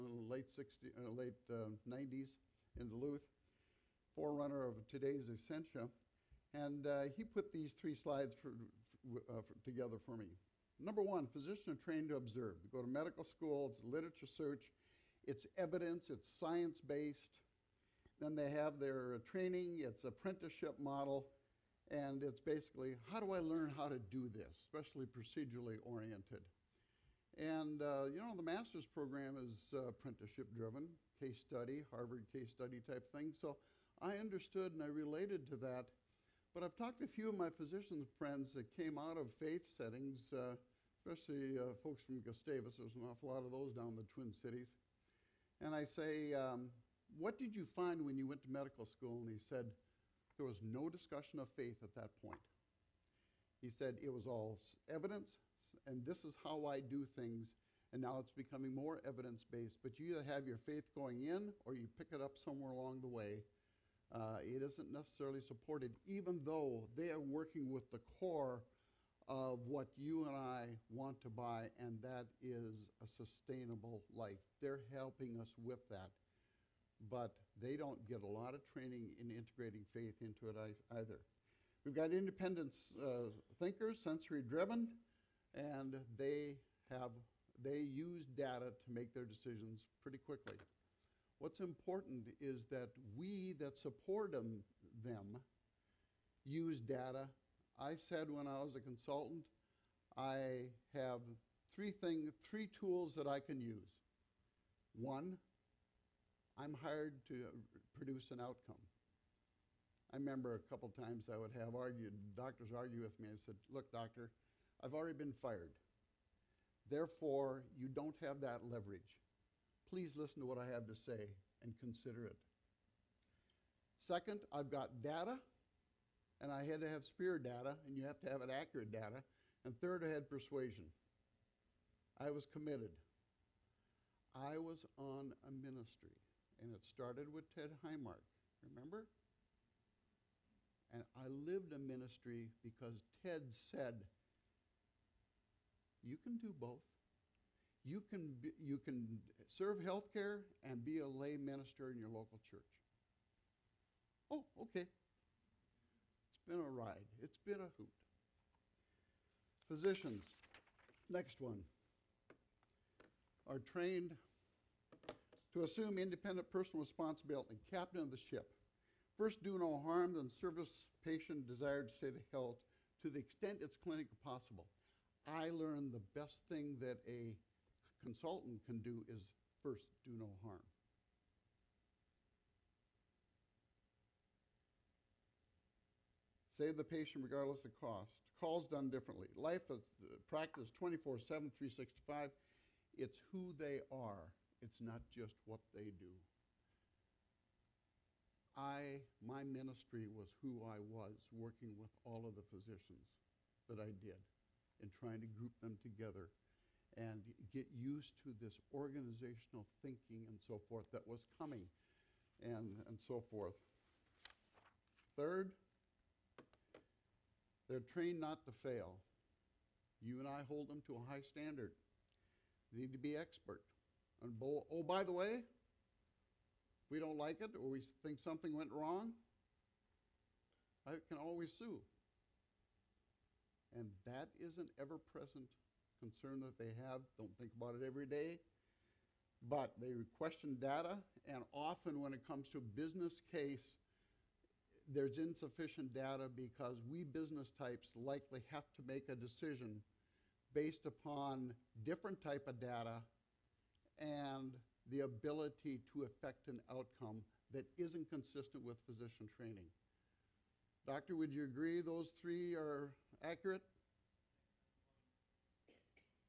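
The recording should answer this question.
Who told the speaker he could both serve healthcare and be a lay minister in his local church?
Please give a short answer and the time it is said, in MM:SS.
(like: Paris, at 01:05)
Ted Heimark, at 02:17.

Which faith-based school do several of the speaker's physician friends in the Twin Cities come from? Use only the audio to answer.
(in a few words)
Gustavus.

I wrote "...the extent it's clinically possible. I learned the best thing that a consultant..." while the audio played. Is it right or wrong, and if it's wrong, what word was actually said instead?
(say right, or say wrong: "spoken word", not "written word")
right.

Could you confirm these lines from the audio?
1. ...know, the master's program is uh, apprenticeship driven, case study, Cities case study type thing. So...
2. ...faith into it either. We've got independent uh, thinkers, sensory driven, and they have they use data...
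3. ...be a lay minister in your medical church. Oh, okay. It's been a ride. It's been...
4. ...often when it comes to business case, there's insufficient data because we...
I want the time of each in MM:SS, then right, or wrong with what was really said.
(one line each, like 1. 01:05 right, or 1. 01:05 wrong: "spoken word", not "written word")
1. 00:28 wrong: "Harvard", not "Cities"
2. 01:19 right
3. 02:30 wrong: "local", not "medical"
4. 04:01 right.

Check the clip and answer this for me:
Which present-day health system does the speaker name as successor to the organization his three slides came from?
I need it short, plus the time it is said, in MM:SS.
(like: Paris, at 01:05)
Essentia, at 00:05.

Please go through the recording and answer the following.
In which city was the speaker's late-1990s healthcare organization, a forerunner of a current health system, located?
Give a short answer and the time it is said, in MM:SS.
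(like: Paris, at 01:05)
Duluth, at 00:02.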